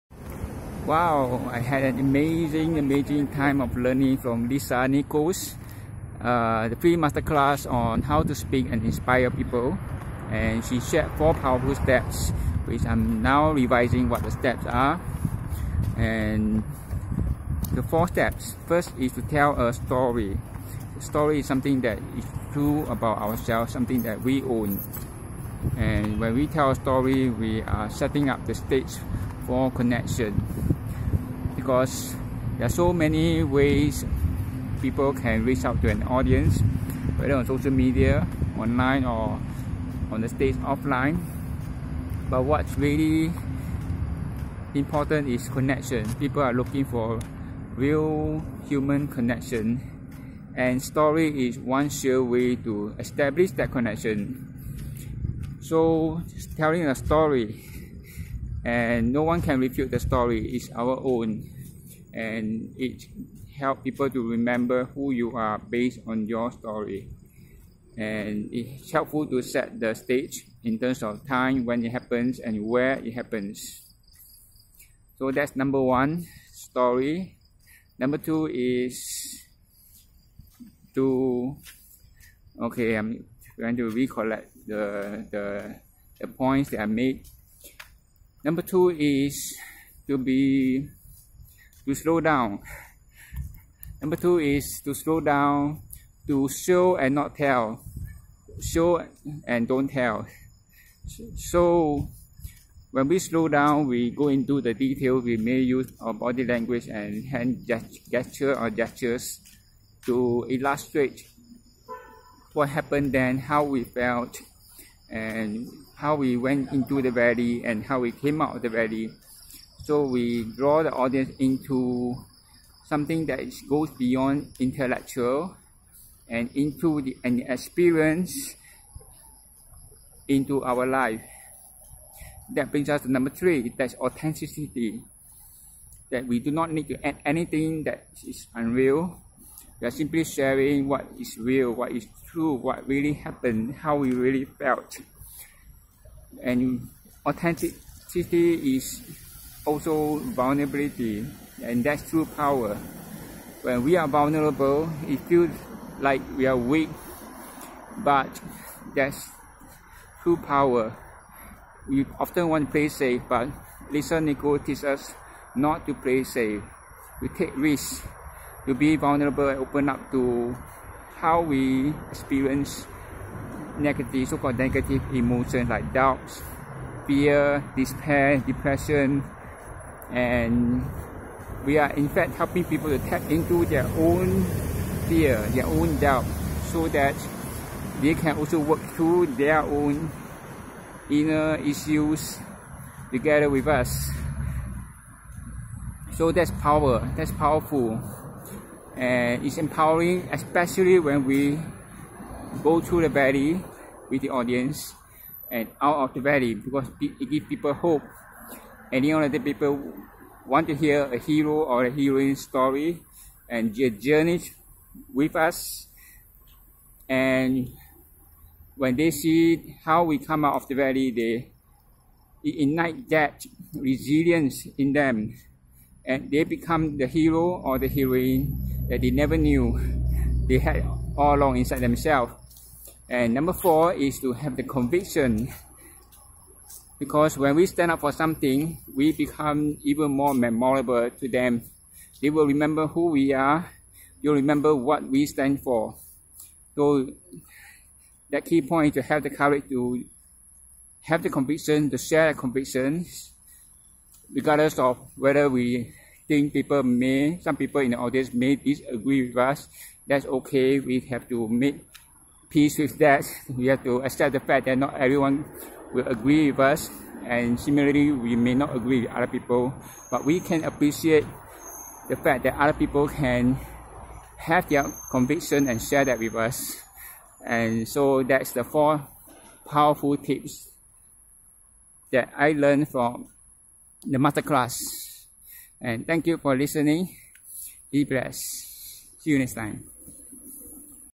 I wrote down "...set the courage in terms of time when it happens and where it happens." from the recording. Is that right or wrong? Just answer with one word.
wrong.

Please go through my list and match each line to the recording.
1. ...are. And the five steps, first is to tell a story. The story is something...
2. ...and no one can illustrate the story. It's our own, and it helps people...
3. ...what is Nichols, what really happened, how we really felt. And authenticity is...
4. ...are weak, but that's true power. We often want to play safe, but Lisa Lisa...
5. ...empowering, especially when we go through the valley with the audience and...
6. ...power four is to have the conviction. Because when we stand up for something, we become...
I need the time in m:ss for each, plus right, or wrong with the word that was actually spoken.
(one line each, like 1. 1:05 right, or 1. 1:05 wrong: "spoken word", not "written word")
1. 0:14 wrong: "four", not "five"
2. 0:58 wrong: "refute", not "illustrate"
3. 2:21 wrong: "True", not "Nichols"
4. 2:36 wrong: "Nichols", not "Lisa"
5. 3:19 right
6. 3:53 wrong: "number", not "power".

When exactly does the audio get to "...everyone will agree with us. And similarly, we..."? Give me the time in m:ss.
4:24.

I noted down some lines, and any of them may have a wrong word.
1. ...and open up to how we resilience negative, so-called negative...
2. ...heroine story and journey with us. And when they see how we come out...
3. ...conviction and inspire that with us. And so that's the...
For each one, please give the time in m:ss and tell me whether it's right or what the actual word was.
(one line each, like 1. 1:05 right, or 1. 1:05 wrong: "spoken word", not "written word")
1. 2:49 wrong: "experience", not "resilience"
2. 3:31 right
3. 4:35 wrong: "share", not "inspire".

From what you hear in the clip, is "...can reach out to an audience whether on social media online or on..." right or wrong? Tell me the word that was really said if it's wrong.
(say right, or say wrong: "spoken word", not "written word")
right.